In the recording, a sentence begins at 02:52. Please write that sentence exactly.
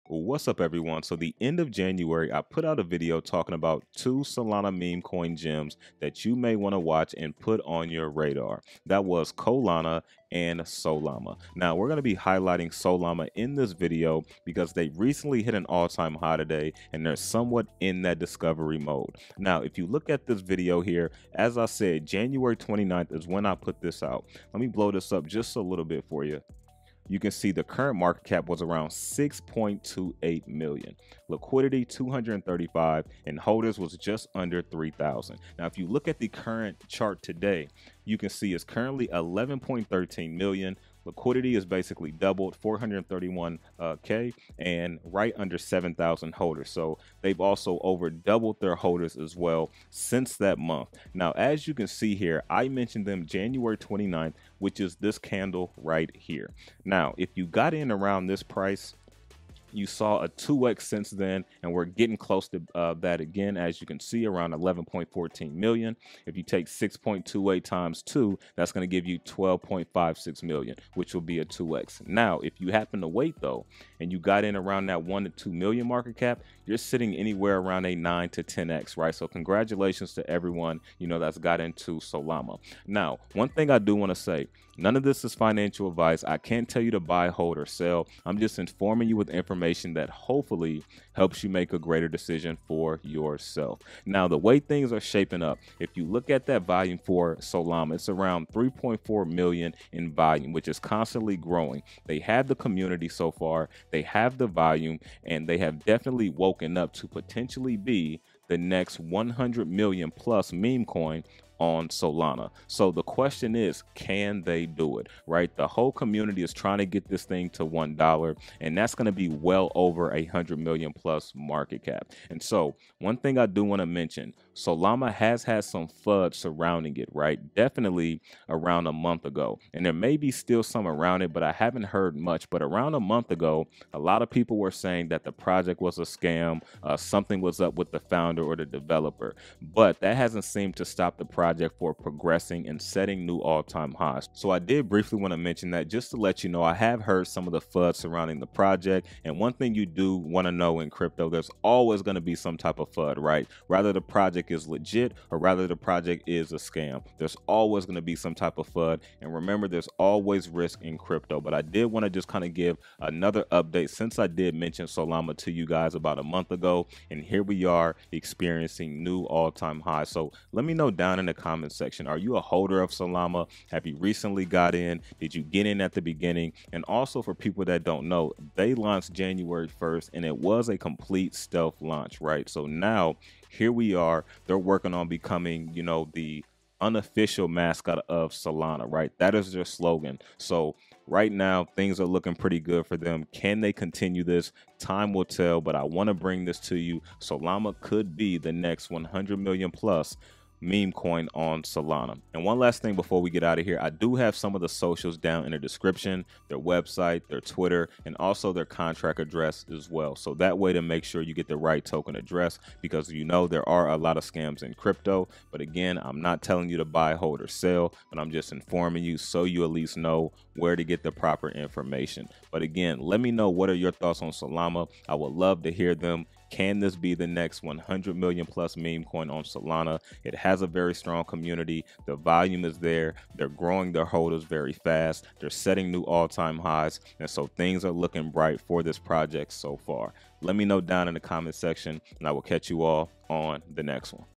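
Are you a holder of Solama?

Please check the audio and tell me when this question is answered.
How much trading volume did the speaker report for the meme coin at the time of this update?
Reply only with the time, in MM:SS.
01:38.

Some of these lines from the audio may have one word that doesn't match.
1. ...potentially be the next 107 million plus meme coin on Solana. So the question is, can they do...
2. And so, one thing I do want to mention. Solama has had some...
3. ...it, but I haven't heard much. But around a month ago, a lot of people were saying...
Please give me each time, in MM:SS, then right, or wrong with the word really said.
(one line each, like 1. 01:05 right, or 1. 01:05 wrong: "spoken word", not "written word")
1. 01:47 wrong: "100", not "107"
2. 02:02 right
3. 02:11 right.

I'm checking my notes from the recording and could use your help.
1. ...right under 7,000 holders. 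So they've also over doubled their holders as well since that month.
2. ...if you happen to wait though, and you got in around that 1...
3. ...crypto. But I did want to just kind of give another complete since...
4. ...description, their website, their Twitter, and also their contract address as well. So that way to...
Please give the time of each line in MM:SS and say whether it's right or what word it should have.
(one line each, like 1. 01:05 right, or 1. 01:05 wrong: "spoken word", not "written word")
1. 00:45 right
2. 01:12 right
3. 02:40 wrong: "update", not "complete"
4. 03:25 right.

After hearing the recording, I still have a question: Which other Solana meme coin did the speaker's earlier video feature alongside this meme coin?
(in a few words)
Colana.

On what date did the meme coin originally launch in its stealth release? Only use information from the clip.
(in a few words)
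January 1st.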